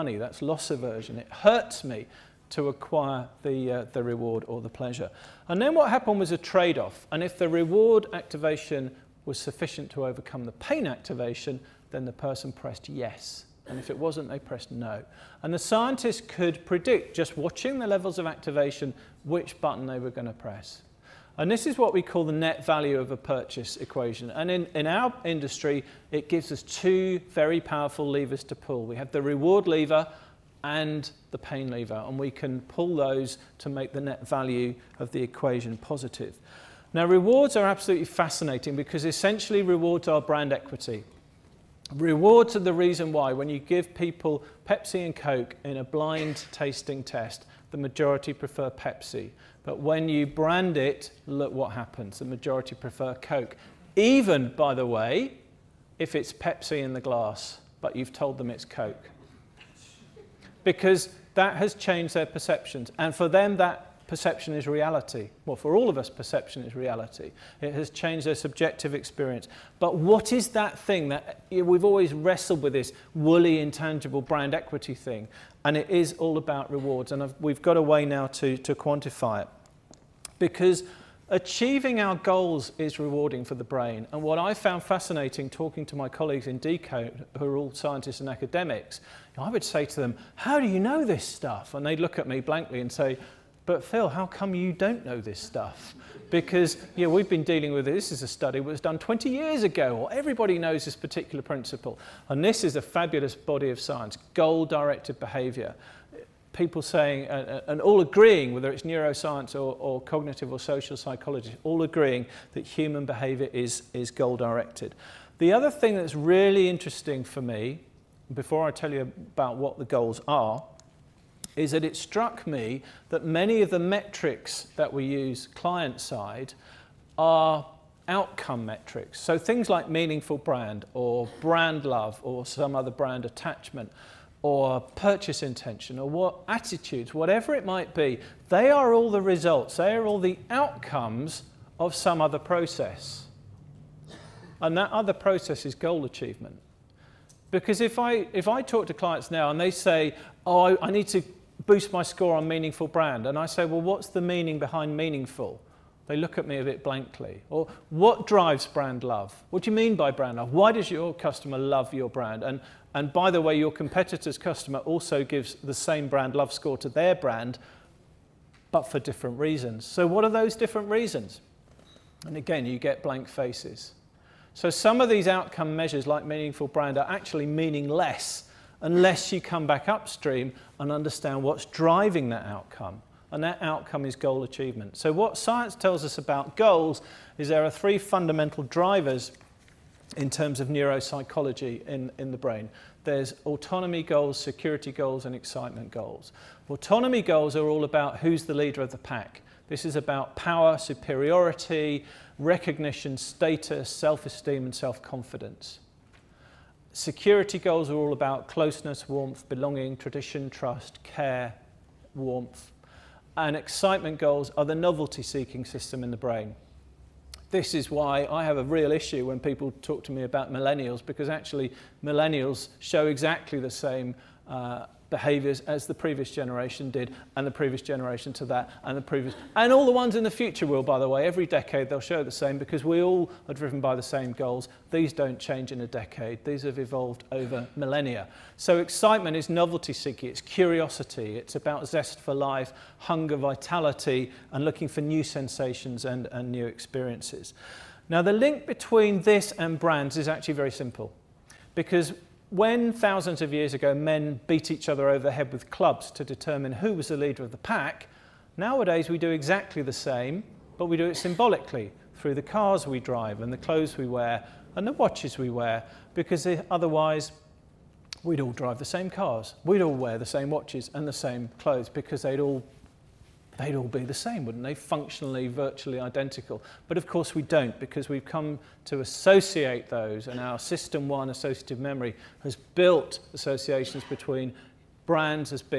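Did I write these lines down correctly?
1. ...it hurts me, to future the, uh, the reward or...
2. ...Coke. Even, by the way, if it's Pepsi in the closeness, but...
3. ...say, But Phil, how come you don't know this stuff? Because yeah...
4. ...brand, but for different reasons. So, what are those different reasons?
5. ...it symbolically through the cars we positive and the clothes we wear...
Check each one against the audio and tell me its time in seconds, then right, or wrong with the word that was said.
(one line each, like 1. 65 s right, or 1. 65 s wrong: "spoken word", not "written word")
1. 1 s wrong: "acquire", not "future"
2. 53 s wrong: "glass", not "closeness"
3. 92 s right
4. 167 s right
5. 261 s wrong: "drive", not "positive".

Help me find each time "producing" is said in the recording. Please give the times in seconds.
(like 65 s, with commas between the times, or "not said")
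not said.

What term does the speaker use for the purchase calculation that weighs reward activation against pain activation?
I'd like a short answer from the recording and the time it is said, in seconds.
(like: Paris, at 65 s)
net value of a purchase equation, at 22 s.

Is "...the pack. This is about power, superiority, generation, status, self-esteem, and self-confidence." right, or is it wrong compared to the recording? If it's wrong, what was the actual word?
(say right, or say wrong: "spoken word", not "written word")
wrong: "recognition", not "generation".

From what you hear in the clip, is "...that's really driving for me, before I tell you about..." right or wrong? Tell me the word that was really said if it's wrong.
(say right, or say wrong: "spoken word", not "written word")
wrong: "interesting", not "driving".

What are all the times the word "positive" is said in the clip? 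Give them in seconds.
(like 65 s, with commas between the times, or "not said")
35 s.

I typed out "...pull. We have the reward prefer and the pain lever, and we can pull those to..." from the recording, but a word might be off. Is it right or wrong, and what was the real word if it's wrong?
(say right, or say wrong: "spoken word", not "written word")
wrong: "lever", not "prefer".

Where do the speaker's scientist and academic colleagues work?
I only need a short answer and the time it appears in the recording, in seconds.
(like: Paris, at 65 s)
Decode, at 86 s.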